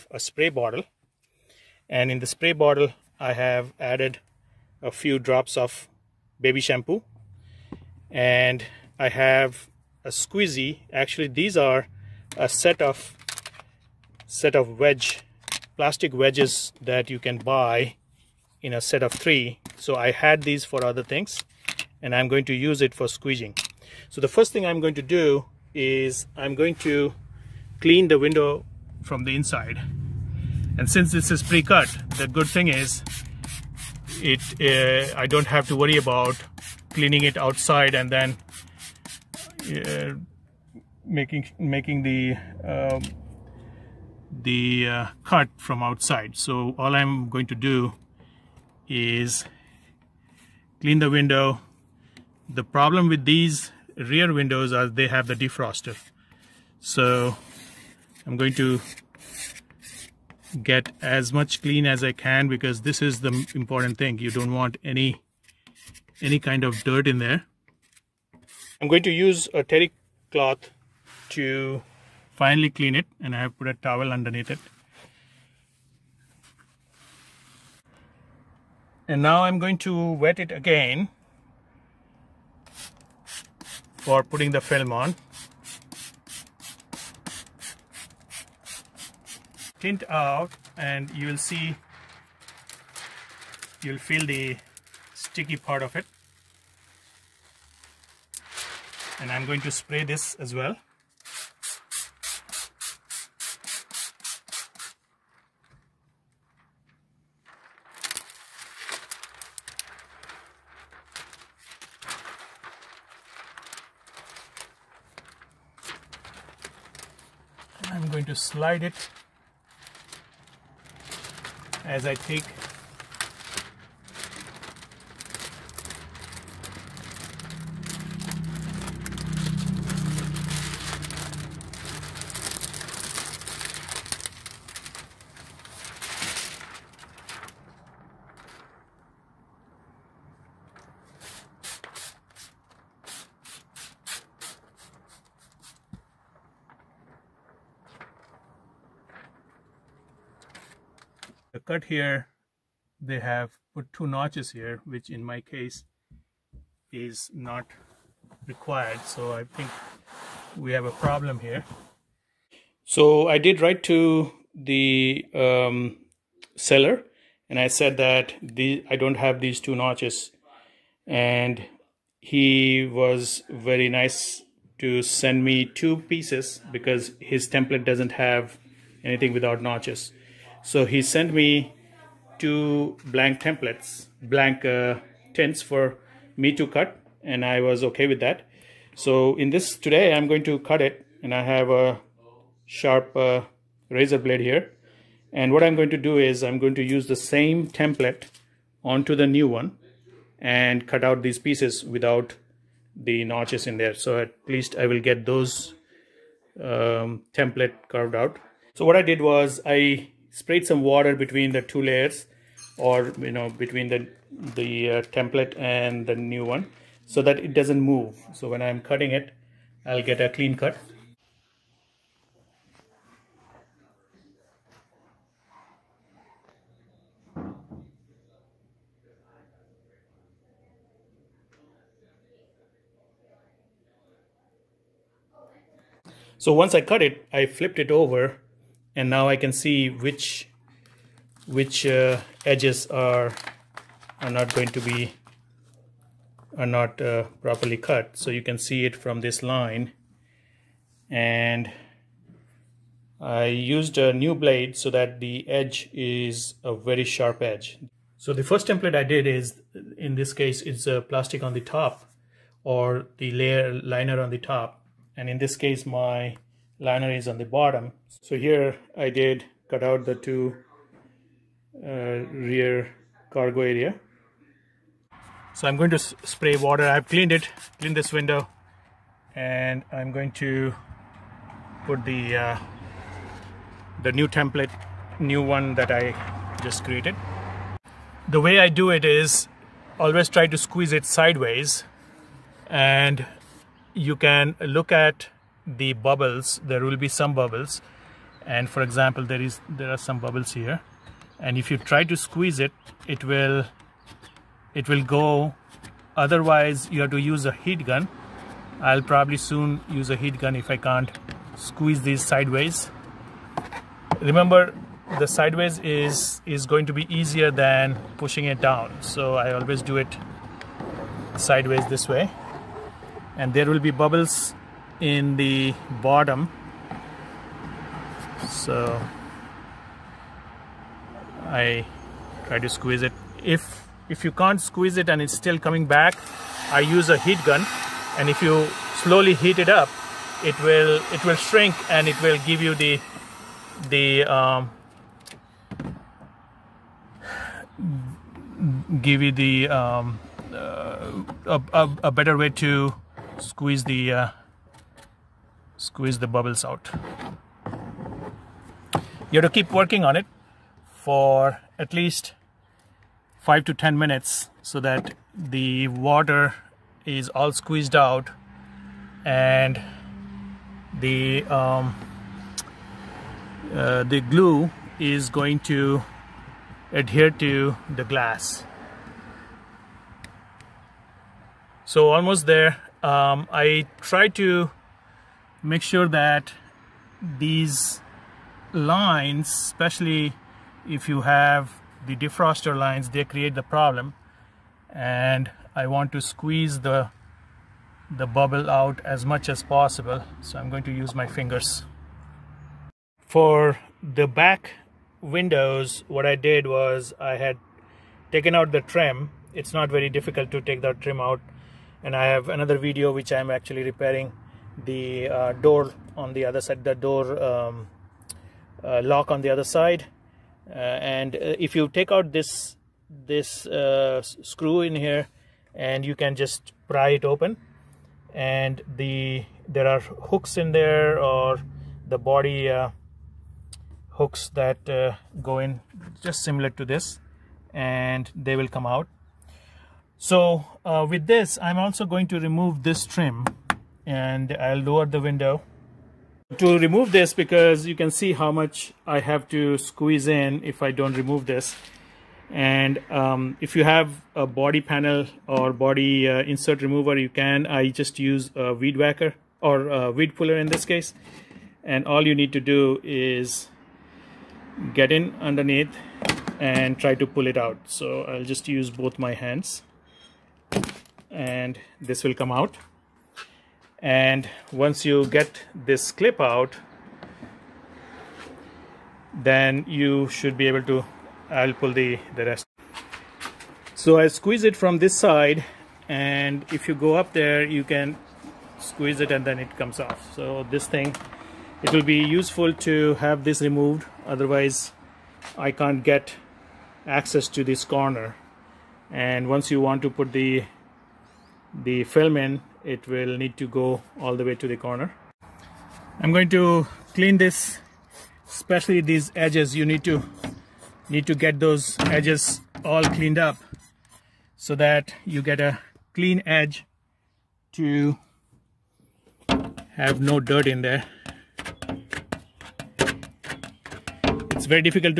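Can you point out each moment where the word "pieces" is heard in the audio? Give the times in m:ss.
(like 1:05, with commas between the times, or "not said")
2:55, 3:21.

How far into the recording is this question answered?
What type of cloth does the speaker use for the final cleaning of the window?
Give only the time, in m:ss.
1:09.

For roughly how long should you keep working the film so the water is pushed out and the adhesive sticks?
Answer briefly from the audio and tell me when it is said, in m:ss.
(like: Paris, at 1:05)
5 to 10 minutes, at 6:03.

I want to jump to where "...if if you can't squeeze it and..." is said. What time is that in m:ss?
5:33.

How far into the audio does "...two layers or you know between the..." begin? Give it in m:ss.
3:31.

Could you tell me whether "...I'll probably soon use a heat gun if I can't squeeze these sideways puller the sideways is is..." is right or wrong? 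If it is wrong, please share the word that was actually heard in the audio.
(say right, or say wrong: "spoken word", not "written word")
wrong: "remember", not "puller".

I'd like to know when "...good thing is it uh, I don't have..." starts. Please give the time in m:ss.
0:32.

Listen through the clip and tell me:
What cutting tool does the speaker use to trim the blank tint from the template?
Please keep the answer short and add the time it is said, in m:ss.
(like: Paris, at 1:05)
Razor blade, at 3:13.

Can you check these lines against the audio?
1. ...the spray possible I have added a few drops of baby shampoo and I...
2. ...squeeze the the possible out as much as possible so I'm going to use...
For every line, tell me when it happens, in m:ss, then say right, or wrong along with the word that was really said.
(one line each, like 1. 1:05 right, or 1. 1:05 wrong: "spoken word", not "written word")
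1. 0:02 wrong: "bottle", not "possible"
2. 6:36 wrong: "bubble", not "possible".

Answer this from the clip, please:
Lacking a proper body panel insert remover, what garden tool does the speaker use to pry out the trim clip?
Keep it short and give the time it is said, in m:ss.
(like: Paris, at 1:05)
Weed puller, at 7:40.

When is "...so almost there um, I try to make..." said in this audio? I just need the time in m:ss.
6:21.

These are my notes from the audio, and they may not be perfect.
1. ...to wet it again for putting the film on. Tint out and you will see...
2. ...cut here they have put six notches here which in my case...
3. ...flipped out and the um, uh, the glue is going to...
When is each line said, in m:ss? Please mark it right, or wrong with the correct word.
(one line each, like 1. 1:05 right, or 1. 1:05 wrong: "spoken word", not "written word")
1. 1:19 right
2. 2:31 wrong: "two", not "six"
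3. 6:07 wrong: "squeezed", not "flipped".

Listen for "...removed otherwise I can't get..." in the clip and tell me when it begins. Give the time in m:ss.
8:13.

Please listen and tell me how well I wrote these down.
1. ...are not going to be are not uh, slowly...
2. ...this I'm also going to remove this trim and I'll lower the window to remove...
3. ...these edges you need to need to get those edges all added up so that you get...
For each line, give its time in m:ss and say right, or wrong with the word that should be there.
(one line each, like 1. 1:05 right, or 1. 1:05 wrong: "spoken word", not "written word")
1. 4:04 wrong: "properly", not "slowly"
2. 7:21 right
3. 8:29 wrong: "cleaned", not "added".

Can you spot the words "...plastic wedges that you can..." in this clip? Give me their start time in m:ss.
0:15.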